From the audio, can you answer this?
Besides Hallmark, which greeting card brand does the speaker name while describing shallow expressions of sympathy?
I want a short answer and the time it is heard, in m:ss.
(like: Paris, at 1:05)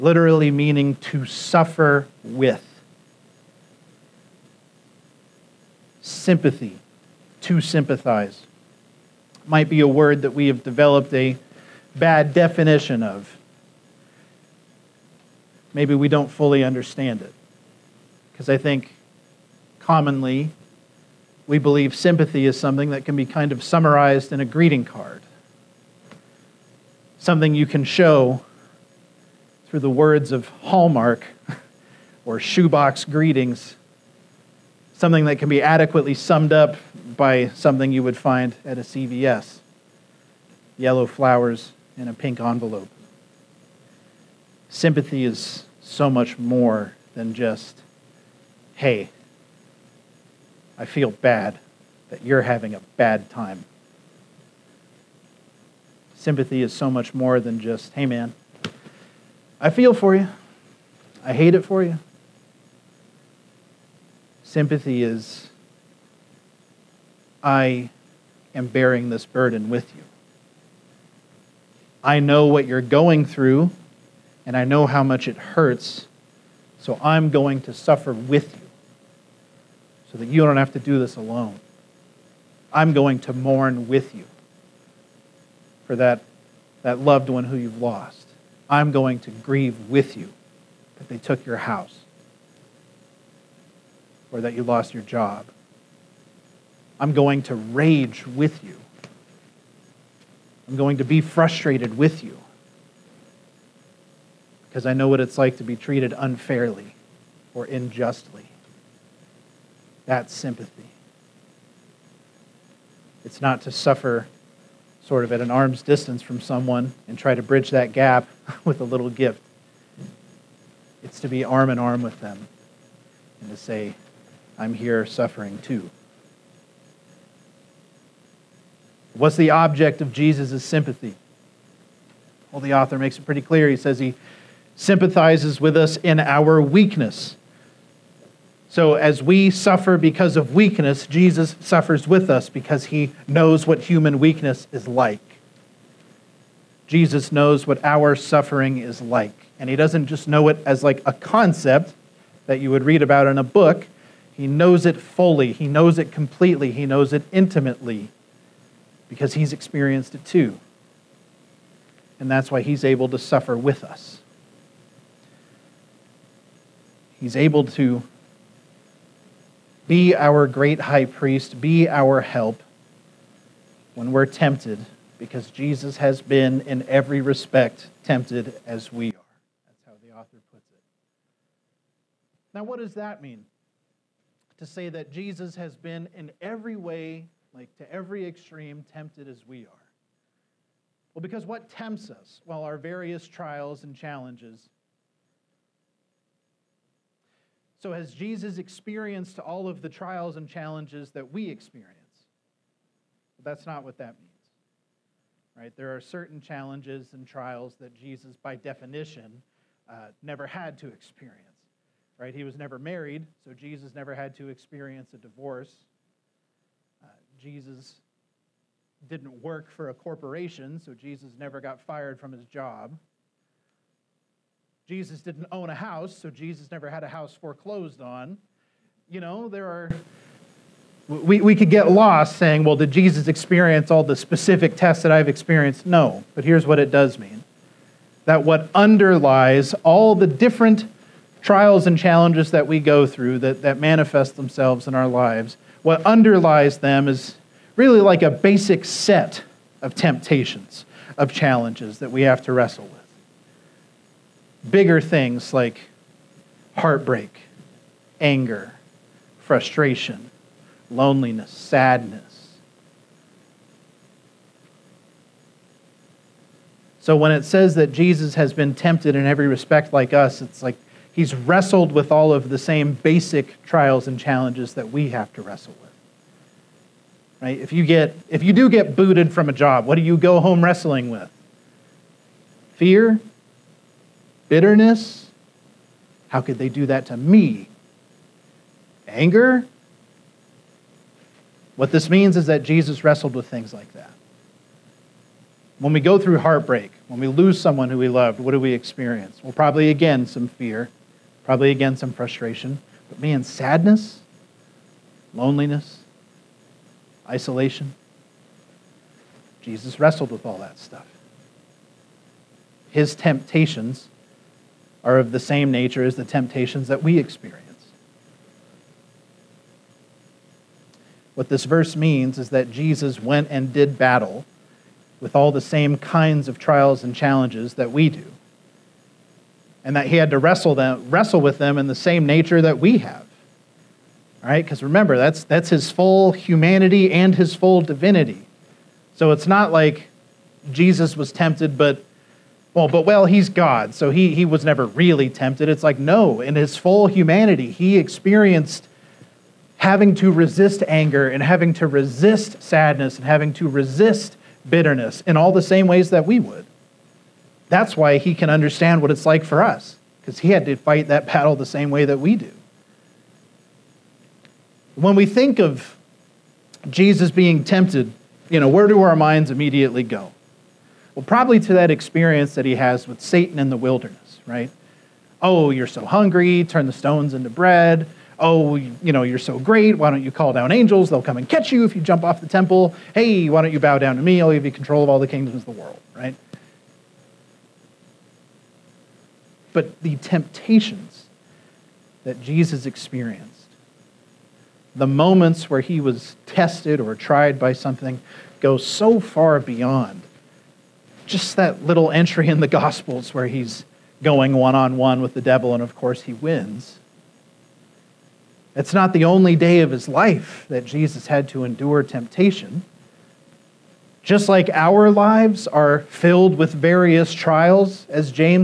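Shoebox Greetings, at 0:32.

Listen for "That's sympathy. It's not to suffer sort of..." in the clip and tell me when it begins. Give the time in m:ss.
1:50.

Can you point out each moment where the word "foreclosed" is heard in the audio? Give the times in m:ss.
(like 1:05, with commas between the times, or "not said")
3:47.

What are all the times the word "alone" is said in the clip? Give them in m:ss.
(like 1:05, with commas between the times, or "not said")
1:21.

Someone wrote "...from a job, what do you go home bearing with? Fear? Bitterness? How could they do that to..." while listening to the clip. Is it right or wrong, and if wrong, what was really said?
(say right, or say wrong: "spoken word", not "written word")
wrong: "wrestling", not "bearing".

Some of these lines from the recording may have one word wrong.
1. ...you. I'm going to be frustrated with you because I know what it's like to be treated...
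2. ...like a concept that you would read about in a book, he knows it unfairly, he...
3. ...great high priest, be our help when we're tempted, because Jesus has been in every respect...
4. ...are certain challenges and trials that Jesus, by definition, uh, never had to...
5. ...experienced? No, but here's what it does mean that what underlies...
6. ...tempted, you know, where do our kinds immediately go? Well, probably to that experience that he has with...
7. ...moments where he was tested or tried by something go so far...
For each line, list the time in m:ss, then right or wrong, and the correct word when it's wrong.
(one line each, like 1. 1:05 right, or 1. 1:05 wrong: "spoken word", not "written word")
1. 1:38 right
2. 2:30 wrong: "fully", not "unfairly"
3. 2:50 right
4. 3:25 right
5. 3:55 right
6. 6:07 wrong: "minds", not "kinds"
7. 6:35 right.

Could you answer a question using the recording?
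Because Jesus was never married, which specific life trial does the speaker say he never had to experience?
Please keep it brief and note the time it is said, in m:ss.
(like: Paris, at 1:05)
divorce, at 3:35.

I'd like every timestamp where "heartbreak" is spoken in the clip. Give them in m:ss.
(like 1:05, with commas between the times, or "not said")
4:16, 4:56.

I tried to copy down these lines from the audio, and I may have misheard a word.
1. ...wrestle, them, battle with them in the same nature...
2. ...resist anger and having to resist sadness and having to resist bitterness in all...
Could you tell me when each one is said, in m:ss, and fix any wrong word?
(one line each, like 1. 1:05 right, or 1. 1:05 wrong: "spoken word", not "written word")
1. 5:30 wrong: "wrestle", not "battle"
2. 5:50 right.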